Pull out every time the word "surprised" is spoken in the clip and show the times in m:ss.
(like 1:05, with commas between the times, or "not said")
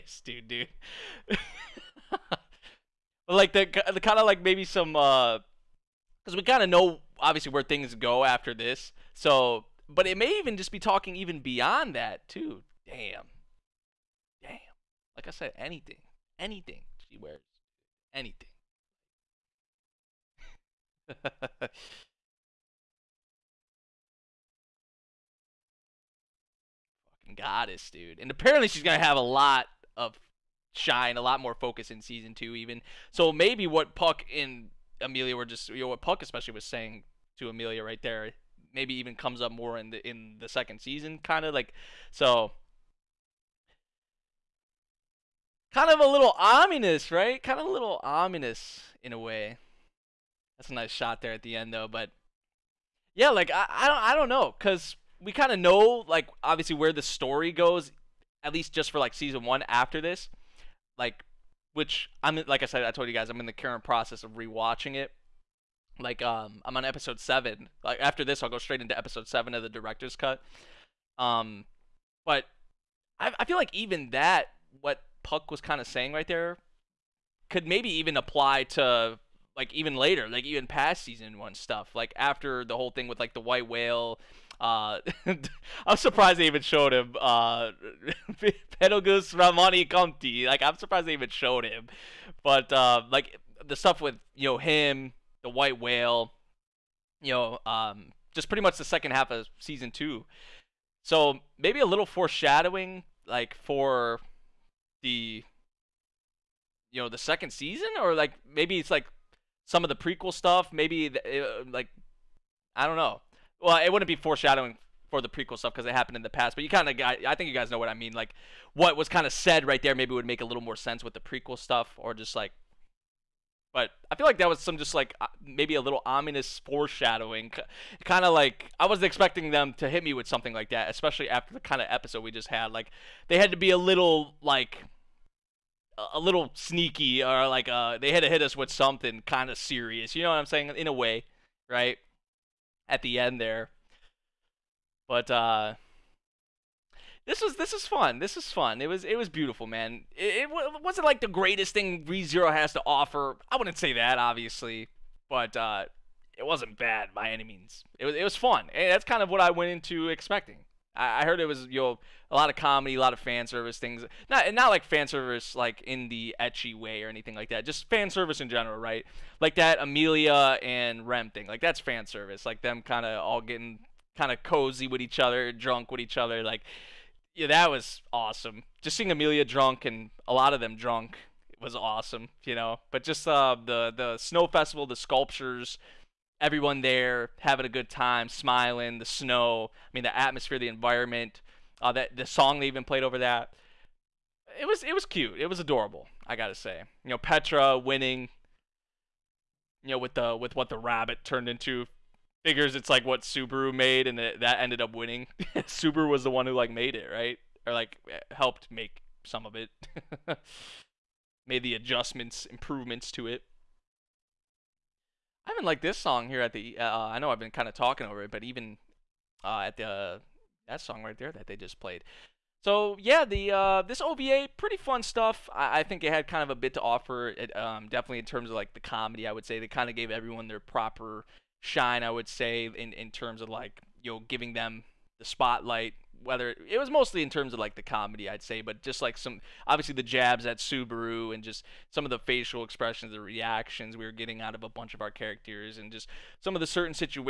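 1:25, 1:30.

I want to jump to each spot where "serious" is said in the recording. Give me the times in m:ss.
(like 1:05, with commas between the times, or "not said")
2:19.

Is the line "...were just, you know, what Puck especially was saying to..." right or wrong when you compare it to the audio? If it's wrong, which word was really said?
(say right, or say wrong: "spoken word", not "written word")
right.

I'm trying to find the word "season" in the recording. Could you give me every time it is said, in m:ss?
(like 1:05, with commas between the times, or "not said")
0:32, 0:40, 0:59, 1:21, 1:39, 1:47.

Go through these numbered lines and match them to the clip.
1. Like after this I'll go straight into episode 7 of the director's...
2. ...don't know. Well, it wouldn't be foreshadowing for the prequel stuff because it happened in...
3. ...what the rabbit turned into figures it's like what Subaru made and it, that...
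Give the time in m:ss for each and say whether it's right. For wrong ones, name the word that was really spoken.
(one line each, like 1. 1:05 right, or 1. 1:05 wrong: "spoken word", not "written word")
1. 1:07 right
2. 1:52 right
3. 3:20 right.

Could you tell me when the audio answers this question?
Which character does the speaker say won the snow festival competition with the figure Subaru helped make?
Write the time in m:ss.
3:17.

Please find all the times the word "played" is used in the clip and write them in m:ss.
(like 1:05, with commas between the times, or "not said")
3:12, 3:41.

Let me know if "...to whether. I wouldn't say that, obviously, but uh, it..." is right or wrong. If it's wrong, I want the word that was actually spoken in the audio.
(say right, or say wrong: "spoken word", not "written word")
wrong: "offer", not "whether".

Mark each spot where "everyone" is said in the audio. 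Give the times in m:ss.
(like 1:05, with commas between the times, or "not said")
3:06, 3:50.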